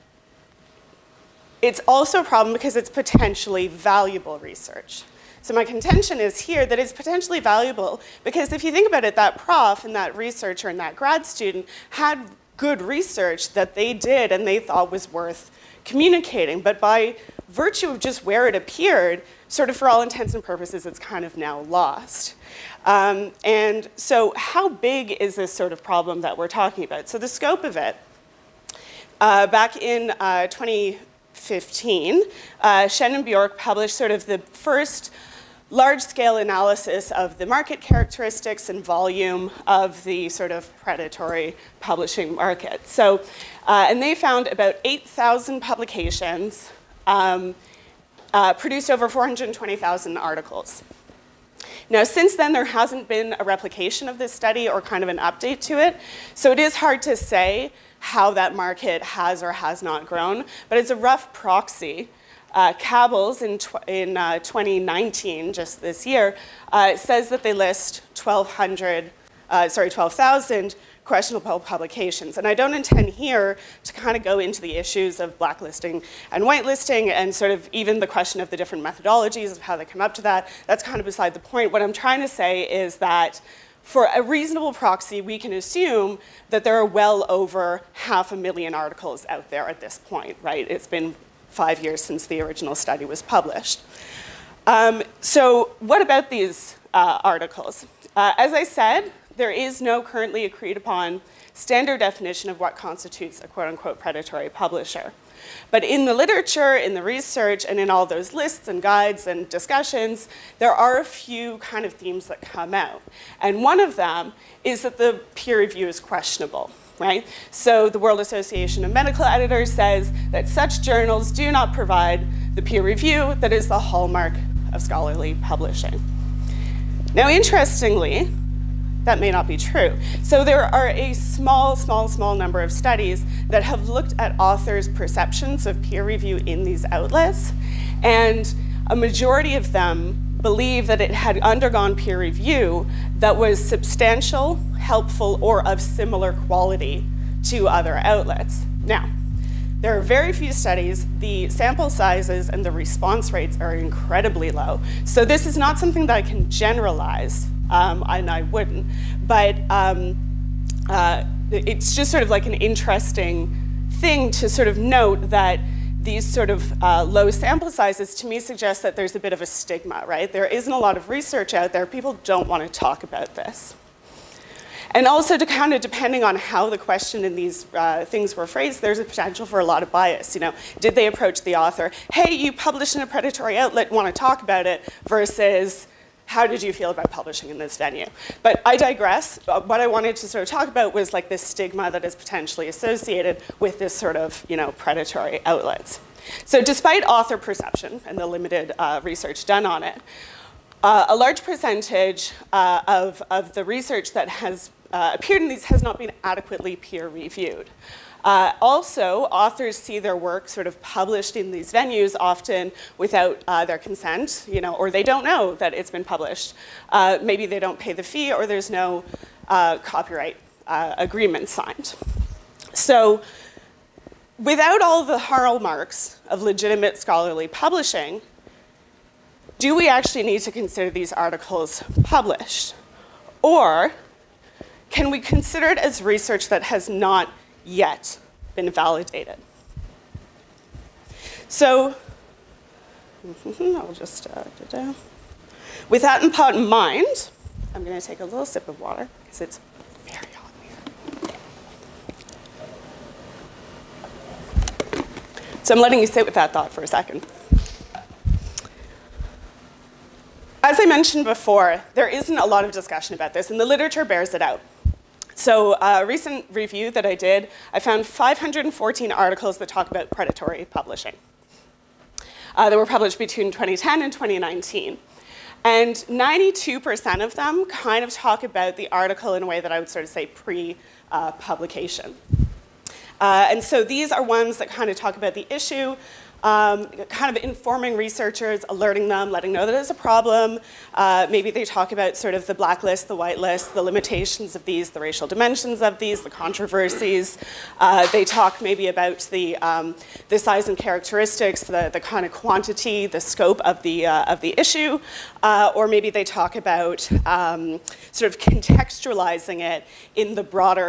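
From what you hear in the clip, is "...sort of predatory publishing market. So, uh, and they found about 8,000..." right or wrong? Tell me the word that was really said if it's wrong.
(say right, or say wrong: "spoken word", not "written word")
right.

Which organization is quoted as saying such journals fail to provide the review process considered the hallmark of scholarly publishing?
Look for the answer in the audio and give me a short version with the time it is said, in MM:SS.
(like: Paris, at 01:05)
World Association of Medical Editors, at 01:57.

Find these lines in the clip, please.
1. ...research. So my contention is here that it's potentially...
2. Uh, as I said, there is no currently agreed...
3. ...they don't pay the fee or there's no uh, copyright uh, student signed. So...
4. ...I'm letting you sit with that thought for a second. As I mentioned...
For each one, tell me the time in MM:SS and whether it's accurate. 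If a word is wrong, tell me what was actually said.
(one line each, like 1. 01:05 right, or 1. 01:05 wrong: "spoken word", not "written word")
1. 00:04 right
2. 01:38 right
3. 03:37 wrong: "agreement", not "student"
4. 04:15 right.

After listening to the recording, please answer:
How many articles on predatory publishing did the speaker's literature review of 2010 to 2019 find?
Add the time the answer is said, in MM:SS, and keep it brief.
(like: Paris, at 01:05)
514, at 04:28.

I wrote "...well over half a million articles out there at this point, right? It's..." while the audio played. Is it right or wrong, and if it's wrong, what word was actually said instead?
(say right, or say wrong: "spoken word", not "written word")
right.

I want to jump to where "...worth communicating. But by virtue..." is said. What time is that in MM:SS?
00:15.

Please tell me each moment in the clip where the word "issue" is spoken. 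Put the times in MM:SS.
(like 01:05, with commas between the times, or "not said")
01:14, 04:45, 05:04.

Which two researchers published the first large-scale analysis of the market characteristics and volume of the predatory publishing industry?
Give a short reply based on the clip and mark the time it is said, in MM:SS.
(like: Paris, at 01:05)
Shen and Björk, at 00:32.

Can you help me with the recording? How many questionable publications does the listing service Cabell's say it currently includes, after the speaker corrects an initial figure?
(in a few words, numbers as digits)
12,000.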